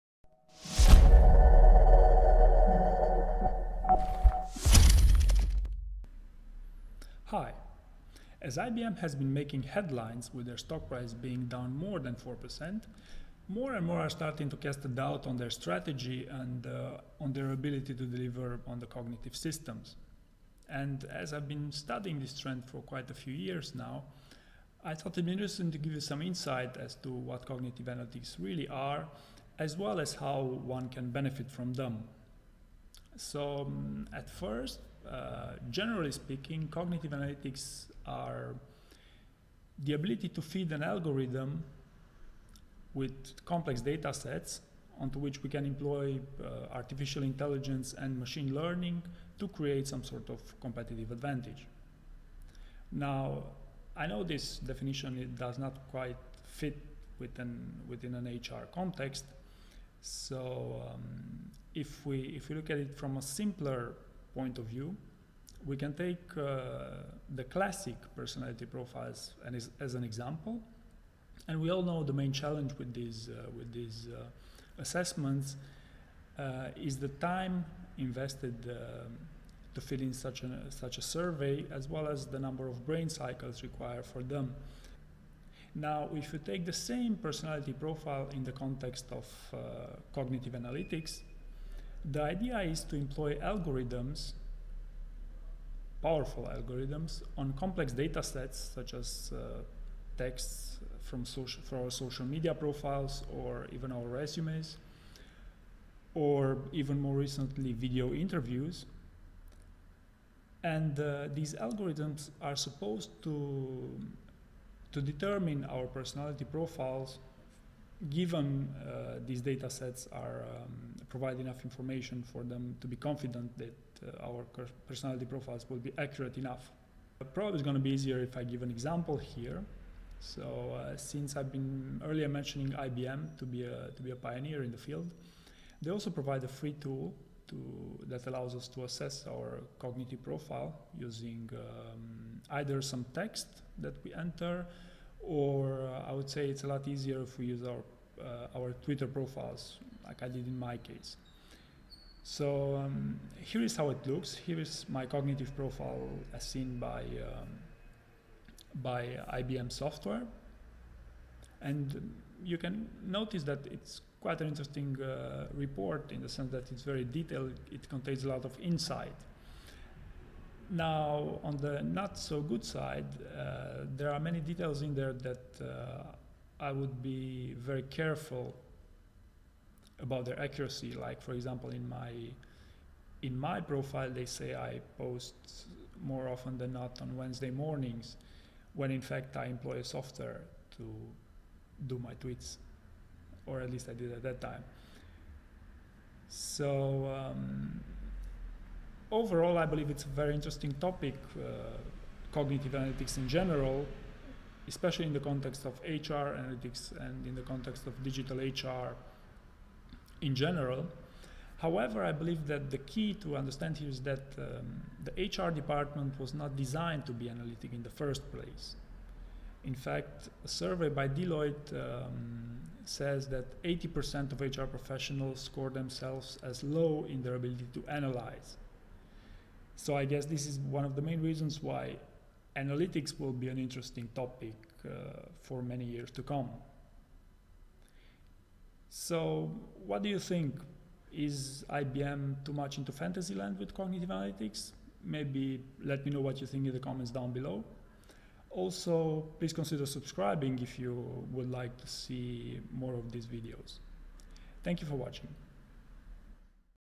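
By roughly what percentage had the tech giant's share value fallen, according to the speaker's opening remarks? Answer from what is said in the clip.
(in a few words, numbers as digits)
more than 4%.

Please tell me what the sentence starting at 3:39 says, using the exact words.
In fact, a survey by Deloitte um, says that 80% of HR professionals score themselves as low in their ability to analyze.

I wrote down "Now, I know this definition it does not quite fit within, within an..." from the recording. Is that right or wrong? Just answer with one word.
right.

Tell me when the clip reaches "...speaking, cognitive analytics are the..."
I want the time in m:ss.
0:36.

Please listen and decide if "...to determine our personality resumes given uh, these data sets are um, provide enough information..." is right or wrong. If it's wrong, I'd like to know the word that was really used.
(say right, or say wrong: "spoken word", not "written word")
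wrong: "profiles", not "resumes".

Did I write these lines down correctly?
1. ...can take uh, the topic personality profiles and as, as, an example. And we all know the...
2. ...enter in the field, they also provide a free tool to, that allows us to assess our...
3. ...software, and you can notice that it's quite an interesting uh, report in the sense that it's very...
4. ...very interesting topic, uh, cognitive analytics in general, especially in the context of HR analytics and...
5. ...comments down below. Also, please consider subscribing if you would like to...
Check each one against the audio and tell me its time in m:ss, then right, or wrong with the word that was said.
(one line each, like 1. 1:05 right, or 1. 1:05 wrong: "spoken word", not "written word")
1. 1:05 wrong: "classic", not "topic"
2. 2:14 wrong: "pioneer", not "enter"
3. 2:39 right
4. 3:20 right
5. 4:06 right.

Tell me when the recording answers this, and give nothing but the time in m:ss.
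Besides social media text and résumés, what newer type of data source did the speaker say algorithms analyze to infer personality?
1:47.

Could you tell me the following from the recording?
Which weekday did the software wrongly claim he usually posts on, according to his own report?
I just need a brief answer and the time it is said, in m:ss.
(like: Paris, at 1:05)
Wednesday, at 3:07.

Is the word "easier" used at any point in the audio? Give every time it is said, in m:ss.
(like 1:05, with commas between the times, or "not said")
2:07, 2:26.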